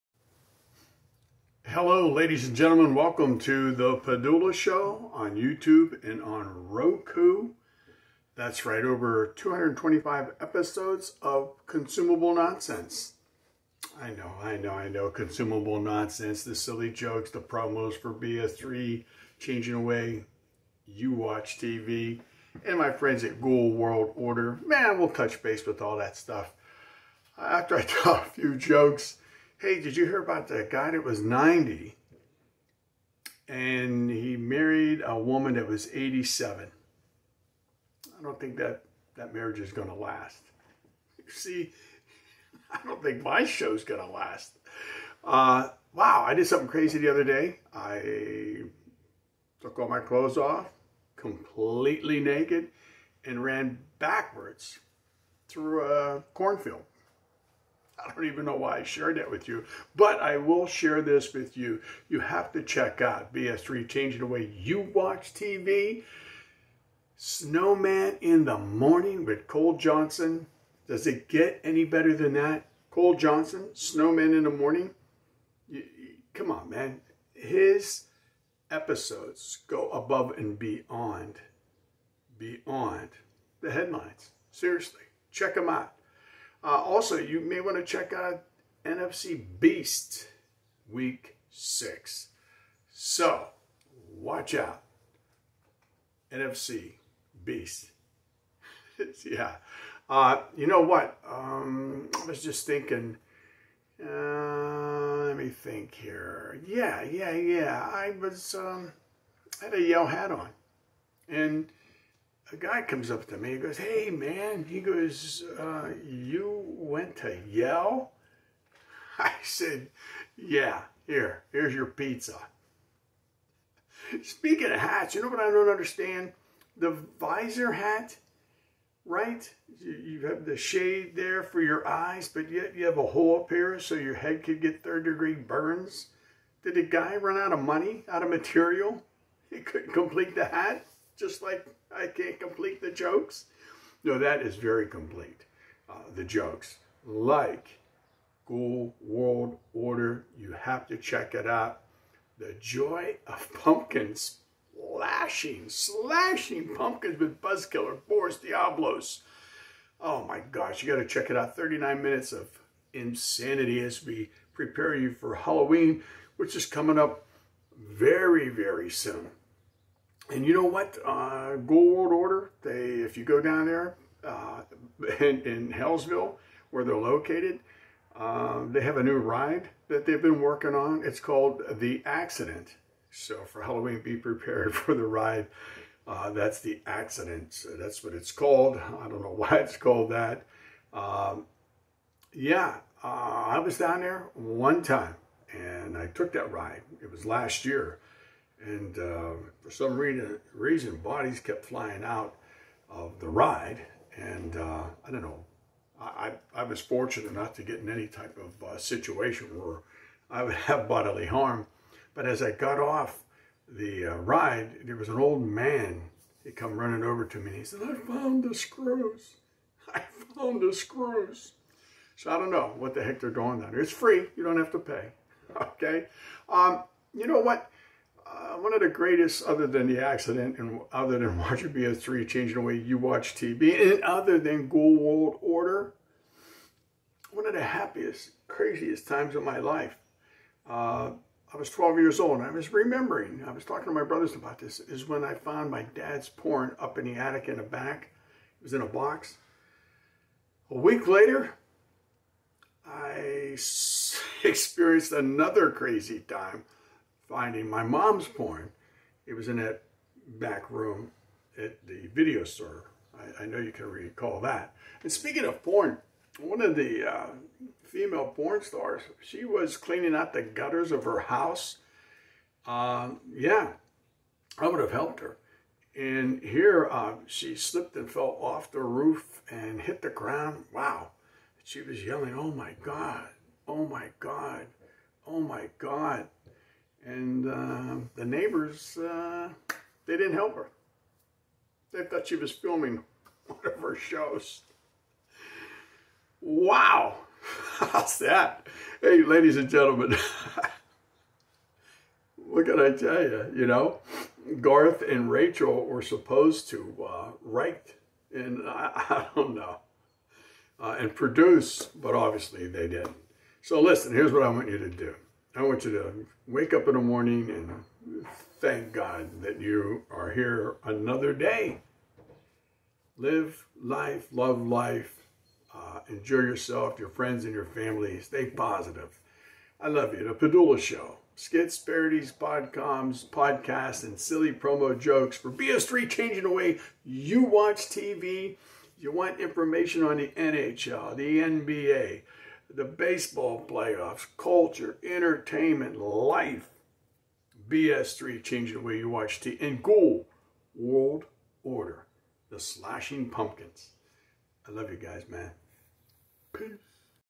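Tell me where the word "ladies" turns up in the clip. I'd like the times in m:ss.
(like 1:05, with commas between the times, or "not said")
0:02, 4:59.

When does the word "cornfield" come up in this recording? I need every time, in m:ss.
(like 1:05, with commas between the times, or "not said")
0:56.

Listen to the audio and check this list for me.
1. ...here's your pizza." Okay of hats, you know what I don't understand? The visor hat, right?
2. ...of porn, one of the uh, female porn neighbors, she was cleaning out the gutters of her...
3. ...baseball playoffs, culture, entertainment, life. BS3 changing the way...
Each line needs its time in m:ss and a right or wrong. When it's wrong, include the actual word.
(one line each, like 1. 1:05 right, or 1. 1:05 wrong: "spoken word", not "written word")
1. 2:01 wrong: "Speaking", not "Okay"
2. 4:25 wrong: "stars", not "neighbors"
3. 5:42 right.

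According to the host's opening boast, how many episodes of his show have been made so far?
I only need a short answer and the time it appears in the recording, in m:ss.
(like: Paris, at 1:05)
225, at 0:09.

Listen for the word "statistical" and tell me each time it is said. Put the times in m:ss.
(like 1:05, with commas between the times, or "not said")
not said.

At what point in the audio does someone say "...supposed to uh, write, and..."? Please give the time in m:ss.
5:06.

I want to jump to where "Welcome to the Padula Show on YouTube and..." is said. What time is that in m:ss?
0:02.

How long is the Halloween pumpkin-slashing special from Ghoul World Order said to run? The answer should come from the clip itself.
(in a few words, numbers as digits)
39 minutes.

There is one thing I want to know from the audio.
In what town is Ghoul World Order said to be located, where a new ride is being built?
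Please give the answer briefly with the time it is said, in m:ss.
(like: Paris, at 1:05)
Hellsville, at 2:55.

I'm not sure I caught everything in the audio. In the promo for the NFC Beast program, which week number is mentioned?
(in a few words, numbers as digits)
6.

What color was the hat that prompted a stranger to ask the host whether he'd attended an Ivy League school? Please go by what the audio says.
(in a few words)
Yellow.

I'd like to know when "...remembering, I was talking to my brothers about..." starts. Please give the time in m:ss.
4:02.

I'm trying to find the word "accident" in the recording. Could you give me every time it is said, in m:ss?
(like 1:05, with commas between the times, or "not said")
3:02, 3:06, 3:50.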